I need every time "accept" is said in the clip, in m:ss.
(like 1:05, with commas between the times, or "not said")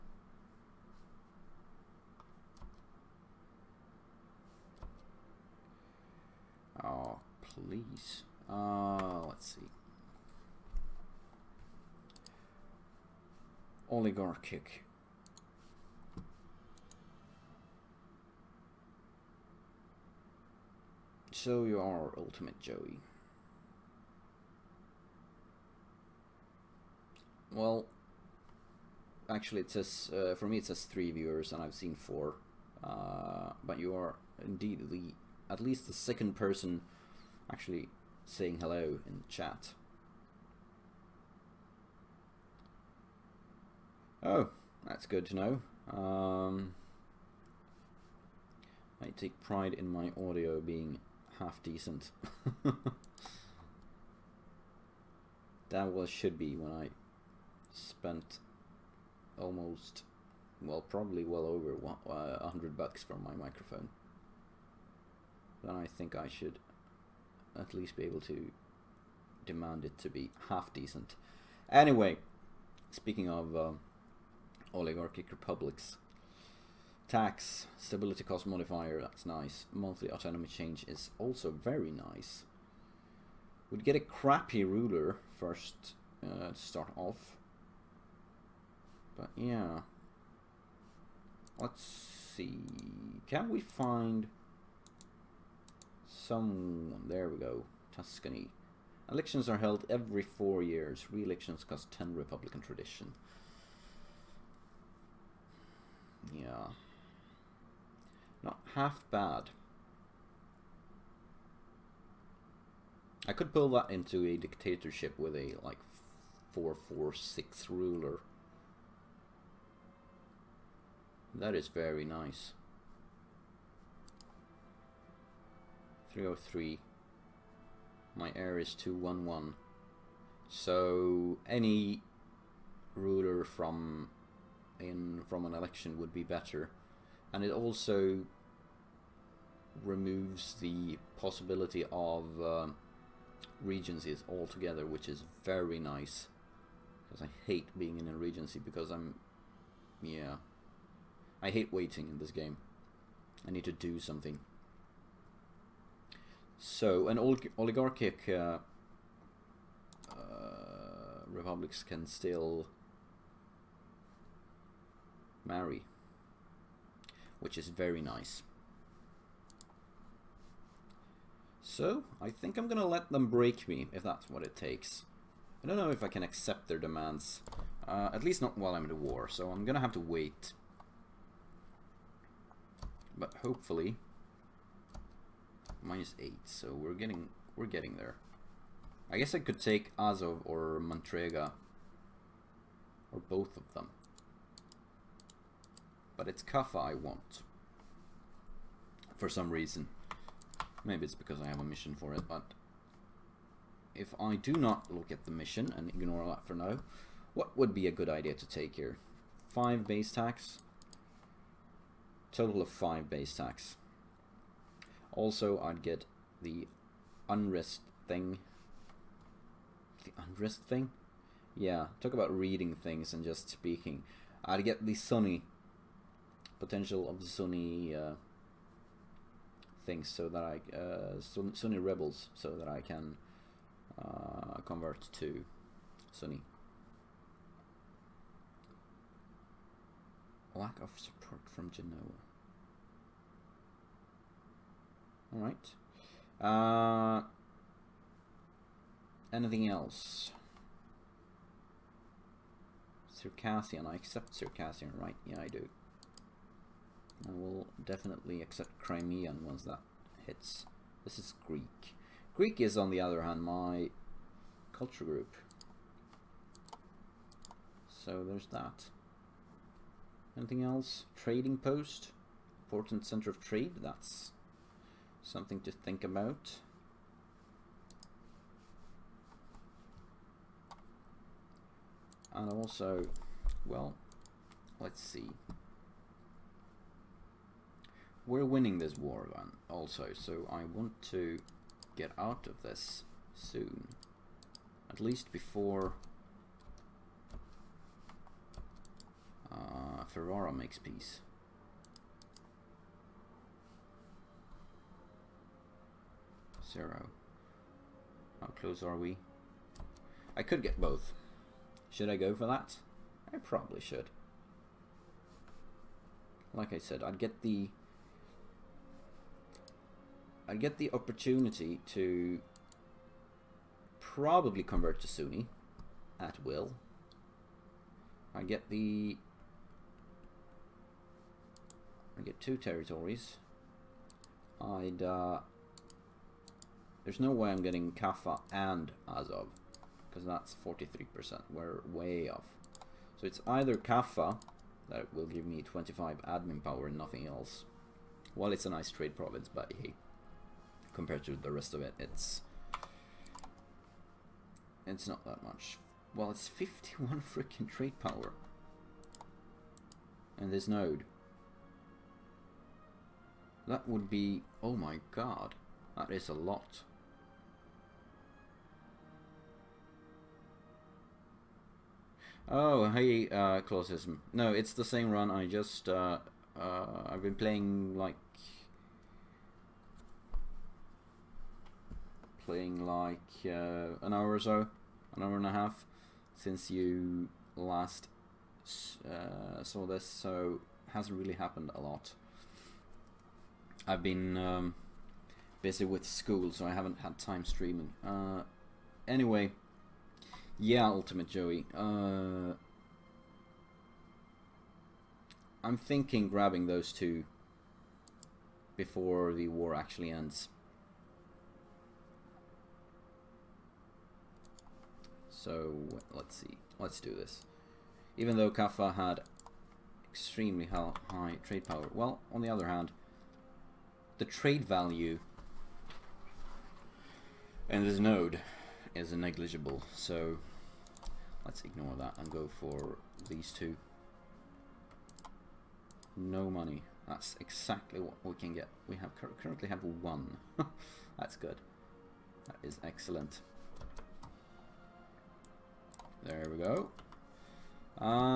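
2:56, 4:13, 4:18.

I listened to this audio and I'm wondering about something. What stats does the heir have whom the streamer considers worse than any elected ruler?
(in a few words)
211.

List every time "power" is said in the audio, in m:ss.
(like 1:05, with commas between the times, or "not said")
5:46, 5:58, 7:01.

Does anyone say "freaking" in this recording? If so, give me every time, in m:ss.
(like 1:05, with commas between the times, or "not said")
5:57.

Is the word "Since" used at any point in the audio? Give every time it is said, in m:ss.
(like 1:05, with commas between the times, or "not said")
6:26.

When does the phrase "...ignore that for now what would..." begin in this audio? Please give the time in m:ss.
3:25.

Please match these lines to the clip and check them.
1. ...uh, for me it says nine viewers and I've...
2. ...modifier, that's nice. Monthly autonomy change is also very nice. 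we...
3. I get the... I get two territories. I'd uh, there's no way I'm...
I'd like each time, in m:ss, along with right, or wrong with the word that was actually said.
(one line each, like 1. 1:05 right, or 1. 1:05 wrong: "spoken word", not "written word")
1. 0:30 wrong: "three", not "nine"
2. 1:18 right
3. 5:28 right.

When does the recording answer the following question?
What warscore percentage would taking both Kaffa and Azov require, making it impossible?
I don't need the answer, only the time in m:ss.
5:40.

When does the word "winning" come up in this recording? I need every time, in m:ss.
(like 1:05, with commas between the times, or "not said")
4:48.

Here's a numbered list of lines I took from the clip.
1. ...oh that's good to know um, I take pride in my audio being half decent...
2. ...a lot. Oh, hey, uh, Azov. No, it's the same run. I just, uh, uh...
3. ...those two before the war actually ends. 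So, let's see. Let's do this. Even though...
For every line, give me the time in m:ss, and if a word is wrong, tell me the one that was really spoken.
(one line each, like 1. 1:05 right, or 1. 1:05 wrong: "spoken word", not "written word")
1. 0:44 right
2. 6:06 wrong: "Clausism", not "Azov"
3. 6:46 right.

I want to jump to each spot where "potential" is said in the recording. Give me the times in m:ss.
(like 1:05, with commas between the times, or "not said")
3:46.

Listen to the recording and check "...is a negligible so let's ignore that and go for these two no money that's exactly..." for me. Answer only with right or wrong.
right.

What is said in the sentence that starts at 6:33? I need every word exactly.
I've been um, busy with school, so I haven't had time streaming.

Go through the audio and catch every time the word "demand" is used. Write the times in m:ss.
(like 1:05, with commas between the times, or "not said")
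1:09, 2:56.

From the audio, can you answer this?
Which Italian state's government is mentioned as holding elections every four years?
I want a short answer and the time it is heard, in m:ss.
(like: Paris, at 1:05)
Tuscany, at 1:37.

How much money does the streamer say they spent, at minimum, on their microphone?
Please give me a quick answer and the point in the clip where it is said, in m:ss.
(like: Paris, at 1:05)
100 bucks, at 1:02.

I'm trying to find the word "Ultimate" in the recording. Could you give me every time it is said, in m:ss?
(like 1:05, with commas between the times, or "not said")
0:22, 6:40.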